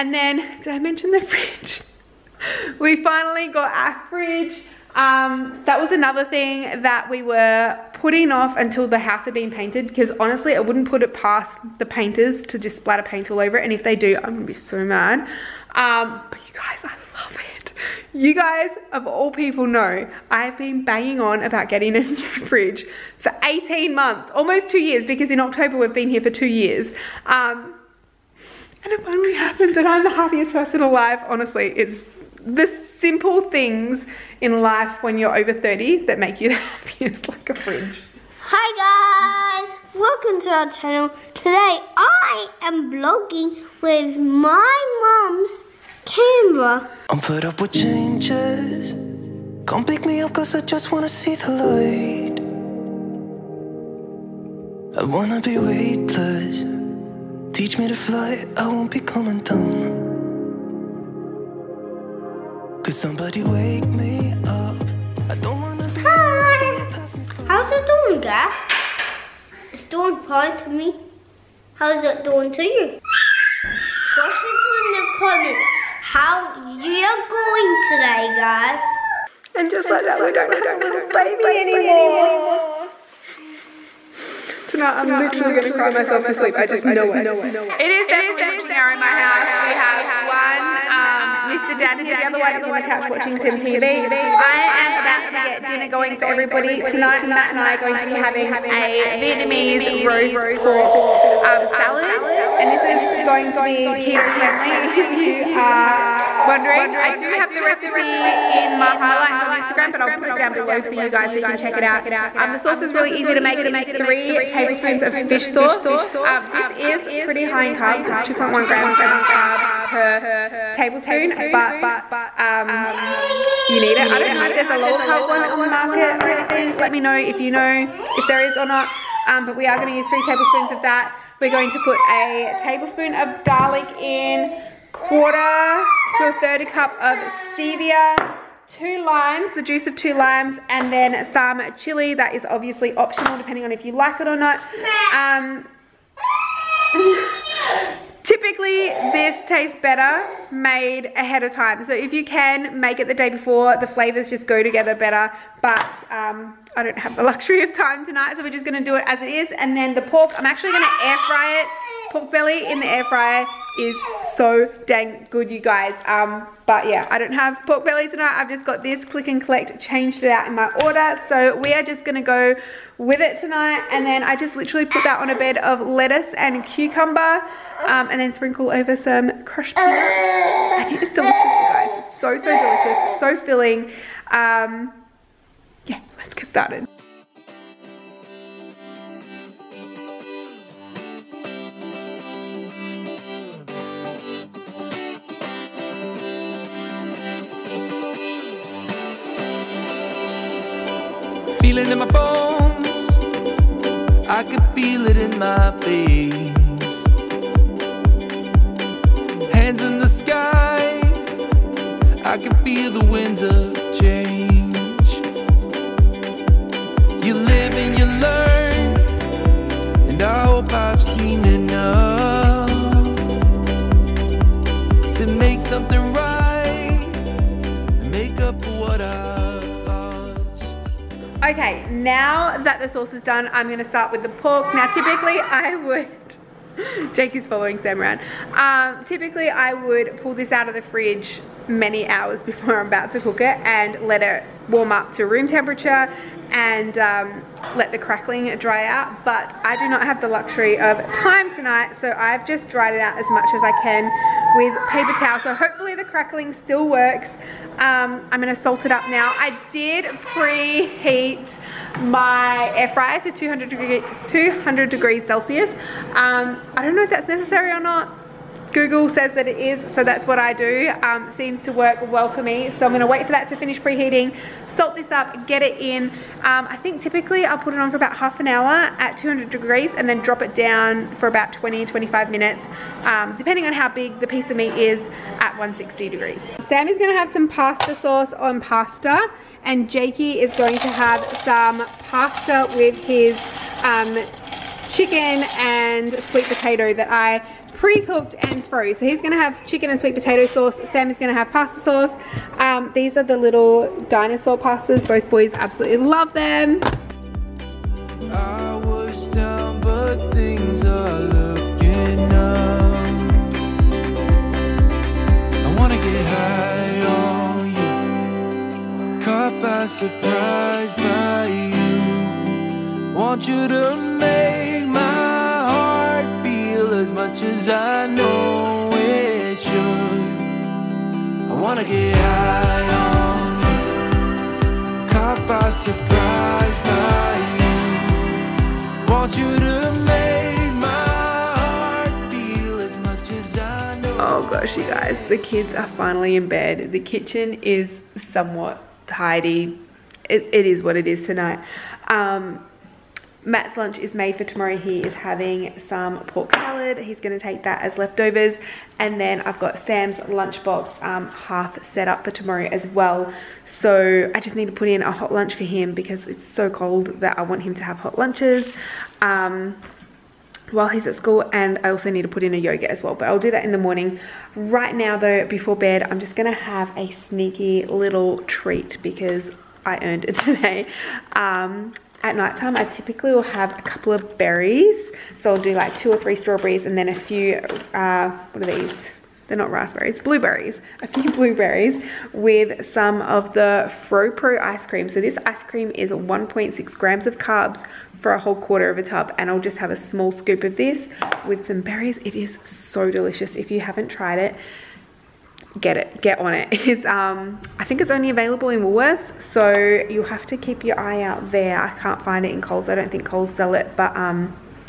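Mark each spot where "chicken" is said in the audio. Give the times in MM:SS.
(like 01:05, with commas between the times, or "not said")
04:54, 04:59.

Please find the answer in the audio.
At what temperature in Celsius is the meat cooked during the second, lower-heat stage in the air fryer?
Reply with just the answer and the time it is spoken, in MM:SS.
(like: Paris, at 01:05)
160 degrees, at 04:45.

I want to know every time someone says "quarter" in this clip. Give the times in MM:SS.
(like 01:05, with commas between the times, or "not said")
02:14, 06:38.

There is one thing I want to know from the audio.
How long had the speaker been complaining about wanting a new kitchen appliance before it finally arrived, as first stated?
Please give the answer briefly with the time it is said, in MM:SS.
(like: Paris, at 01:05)
18 months, at 00:23.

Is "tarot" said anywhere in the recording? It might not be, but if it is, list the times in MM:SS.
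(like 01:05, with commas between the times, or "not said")
not said.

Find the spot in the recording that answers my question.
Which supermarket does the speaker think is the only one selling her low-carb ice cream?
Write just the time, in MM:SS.
06:48.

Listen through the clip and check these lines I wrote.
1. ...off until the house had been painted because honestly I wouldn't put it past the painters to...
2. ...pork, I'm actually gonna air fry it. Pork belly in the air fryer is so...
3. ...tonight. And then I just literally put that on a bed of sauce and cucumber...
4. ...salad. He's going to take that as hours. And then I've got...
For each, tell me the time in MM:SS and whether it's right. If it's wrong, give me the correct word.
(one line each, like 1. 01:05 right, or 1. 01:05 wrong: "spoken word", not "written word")
1. 00:08 right
2. 02:40 right
3. 02:53 wrong: "lettuce", not "sauce"
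4. 05:56 wrong: "leftovers", not "hours".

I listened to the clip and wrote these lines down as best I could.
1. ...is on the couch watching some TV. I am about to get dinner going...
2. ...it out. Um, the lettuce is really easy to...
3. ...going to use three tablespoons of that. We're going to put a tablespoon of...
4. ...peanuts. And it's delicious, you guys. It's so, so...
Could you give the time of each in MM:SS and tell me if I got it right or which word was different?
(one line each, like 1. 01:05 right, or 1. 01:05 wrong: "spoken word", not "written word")
1. 01:32 right
2. 01:51 wrong: "sauce", not "lettuce"
3. 02:09 right
4. 02:59 right.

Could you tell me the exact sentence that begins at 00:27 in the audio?
Um, and it finally happened, and I'm the happiest person alive.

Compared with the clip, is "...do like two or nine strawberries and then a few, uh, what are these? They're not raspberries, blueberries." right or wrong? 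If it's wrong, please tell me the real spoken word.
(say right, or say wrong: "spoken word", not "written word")
wrong: "three", not "nine".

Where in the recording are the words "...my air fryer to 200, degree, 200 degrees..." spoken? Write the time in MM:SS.
04:22.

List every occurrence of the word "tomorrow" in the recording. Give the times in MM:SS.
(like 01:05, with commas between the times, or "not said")
05:54, 06:02.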